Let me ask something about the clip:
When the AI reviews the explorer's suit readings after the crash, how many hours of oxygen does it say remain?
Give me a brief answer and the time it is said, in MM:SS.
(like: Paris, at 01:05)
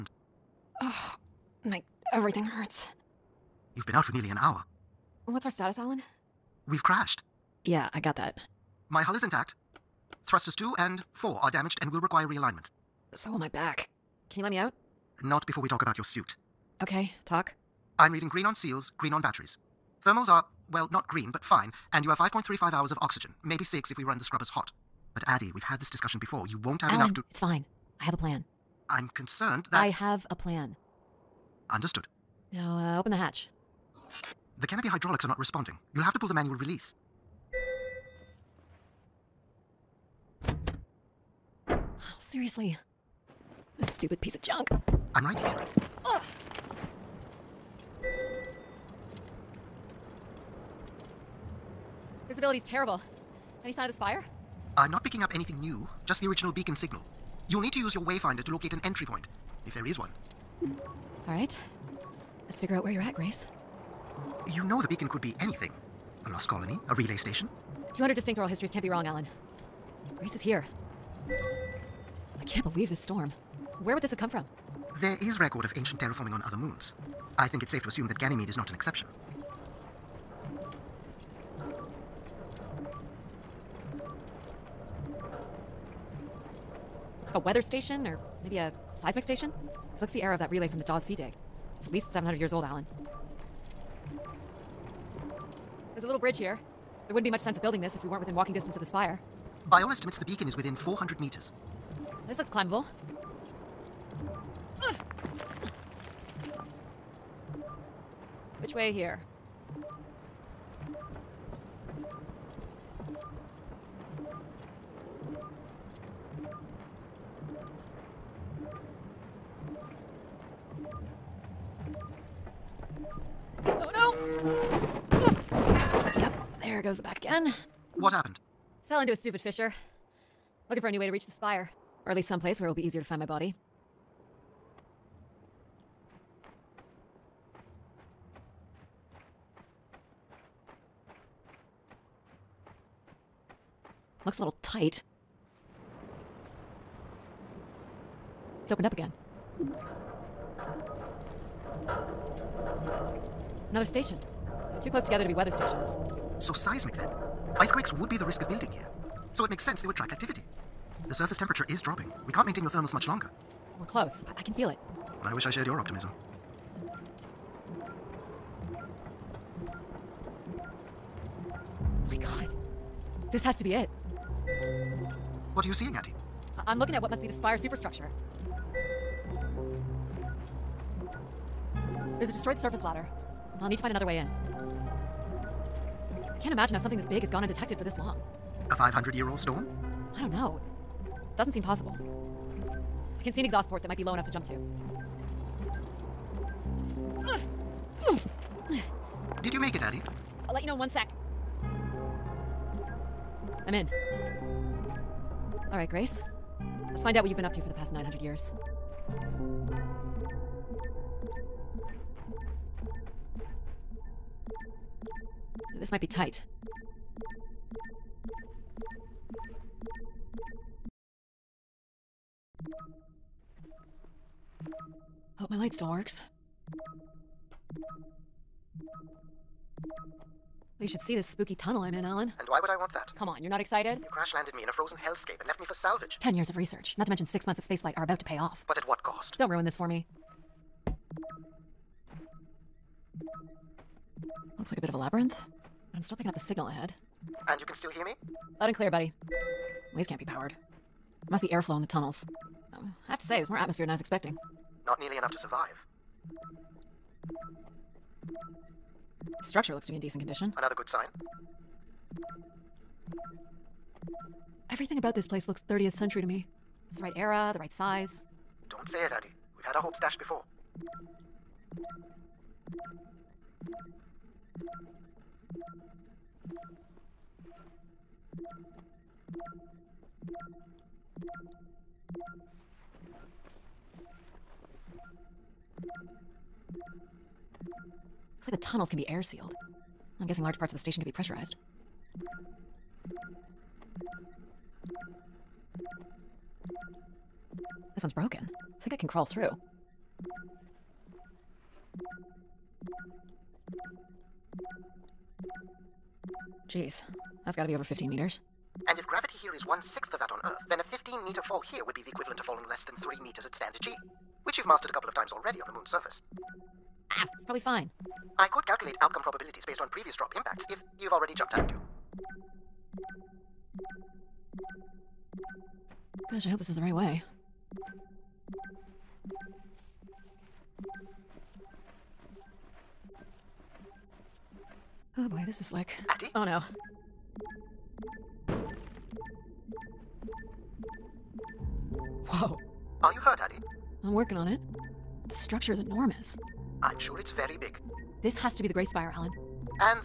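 5.35 hours, at 00:22.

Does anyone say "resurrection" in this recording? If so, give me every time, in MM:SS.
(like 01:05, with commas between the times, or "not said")
not said.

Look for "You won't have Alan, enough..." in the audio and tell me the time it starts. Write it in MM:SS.
00:26.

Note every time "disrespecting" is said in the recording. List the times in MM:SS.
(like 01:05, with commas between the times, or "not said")
not said.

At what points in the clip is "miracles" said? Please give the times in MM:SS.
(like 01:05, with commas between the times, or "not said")
not said.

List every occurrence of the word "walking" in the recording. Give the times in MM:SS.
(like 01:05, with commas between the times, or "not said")
01:38.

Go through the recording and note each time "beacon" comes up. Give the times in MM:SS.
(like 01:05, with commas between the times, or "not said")
00:56, 01:04, 01:40.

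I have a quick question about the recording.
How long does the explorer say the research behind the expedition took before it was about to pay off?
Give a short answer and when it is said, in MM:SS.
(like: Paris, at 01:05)
Ten years, at 03:56.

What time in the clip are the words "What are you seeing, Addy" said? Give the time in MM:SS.
02:55.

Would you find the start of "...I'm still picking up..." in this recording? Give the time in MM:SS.
04:05.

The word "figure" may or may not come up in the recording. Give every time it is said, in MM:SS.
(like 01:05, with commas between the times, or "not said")
01:02.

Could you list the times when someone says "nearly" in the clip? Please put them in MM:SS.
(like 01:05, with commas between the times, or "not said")
00:04, 04:14.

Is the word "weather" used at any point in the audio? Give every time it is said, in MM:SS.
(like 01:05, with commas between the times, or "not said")
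01:27, 02:35.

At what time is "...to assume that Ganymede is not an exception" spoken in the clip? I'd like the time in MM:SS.
01:17.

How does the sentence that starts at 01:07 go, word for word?
200 distinct oral histories can't be wrong, Alan.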